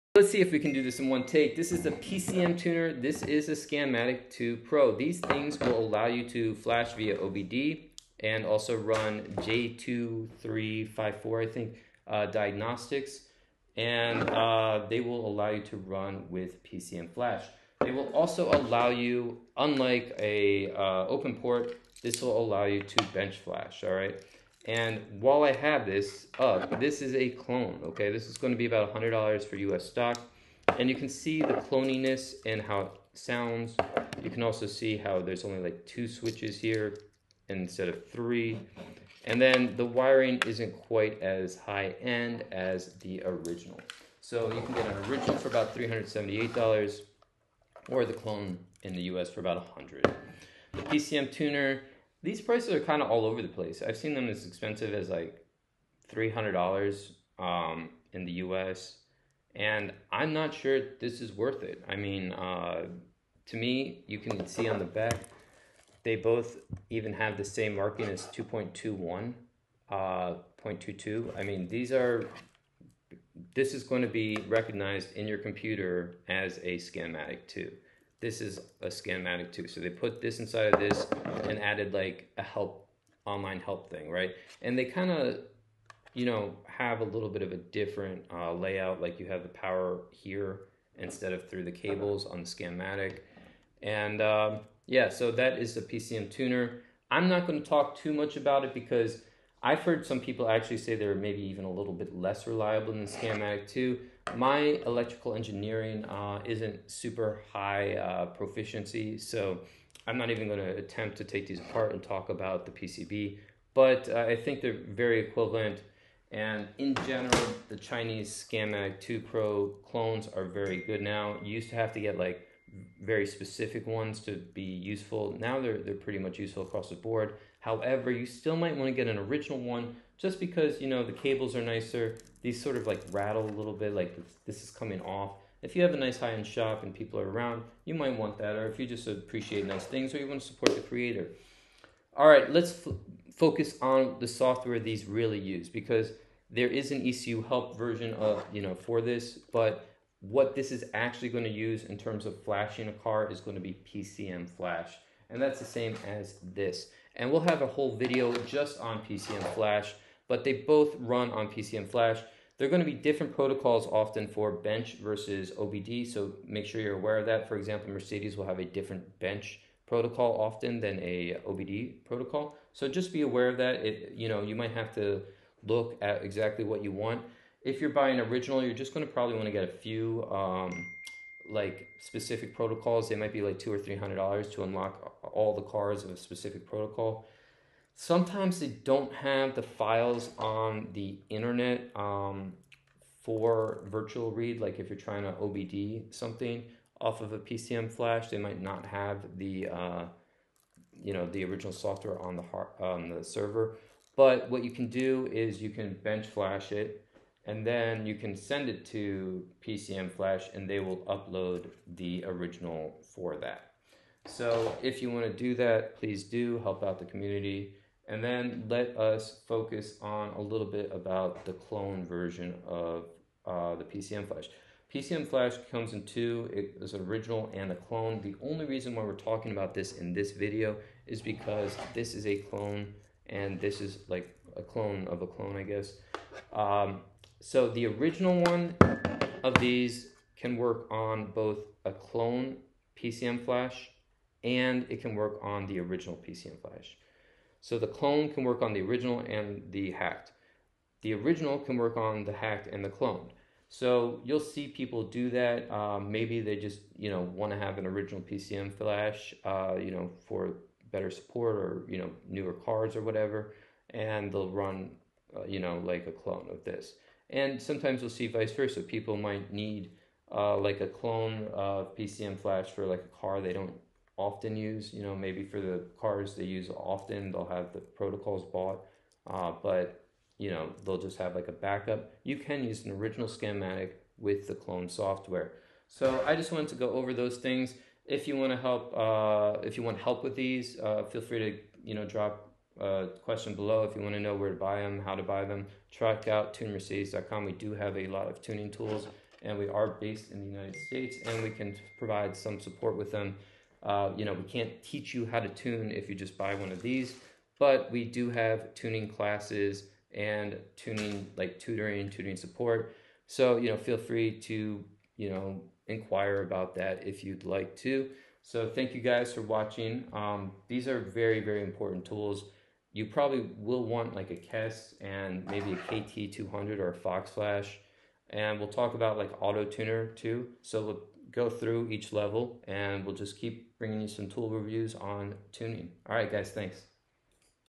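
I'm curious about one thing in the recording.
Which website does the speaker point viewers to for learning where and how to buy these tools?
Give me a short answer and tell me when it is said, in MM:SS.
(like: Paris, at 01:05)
tunedmercedes.com, at 04:56.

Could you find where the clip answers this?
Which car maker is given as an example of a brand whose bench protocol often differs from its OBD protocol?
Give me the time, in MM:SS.
02:47.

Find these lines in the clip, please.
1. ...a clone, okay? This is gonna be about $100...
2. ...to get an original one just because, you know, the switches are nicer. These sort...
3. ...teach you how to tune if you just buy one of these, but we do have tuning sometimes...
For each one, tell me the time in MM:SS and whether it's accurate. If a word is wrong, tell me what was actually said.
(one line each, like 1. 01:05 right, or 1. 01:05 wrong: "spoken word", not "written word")
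1. 00:27 right
2. 02:08 wrong: "cables", not "switches"
3. 05:04 wrong: "classes", not "sometimes".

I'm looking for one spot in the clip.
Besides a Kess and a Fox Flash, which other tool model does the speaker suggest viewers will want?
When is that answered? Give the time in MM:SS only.
05:25.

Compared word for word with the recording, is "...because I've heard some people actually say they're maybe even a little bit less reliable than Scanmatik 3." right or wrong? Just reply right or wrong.
wrong.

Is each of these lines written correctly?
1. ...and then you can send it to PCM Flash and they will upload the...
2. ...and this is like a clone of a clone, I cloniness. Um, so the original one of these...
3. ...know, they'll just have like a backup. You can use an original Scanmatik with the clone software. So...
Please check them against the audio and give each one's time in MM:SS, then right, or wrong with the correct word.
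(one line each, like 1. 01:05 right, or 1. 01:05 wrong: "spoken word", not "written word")
1. 03:27 right
2. 03:53 wrong: "guess", not "cloniness"
3. 04:40 right.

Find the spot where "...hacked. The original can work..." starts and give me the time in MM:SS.
04:09.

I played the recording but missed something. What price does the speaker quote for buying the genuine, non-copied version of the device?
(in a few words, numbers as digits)
$378.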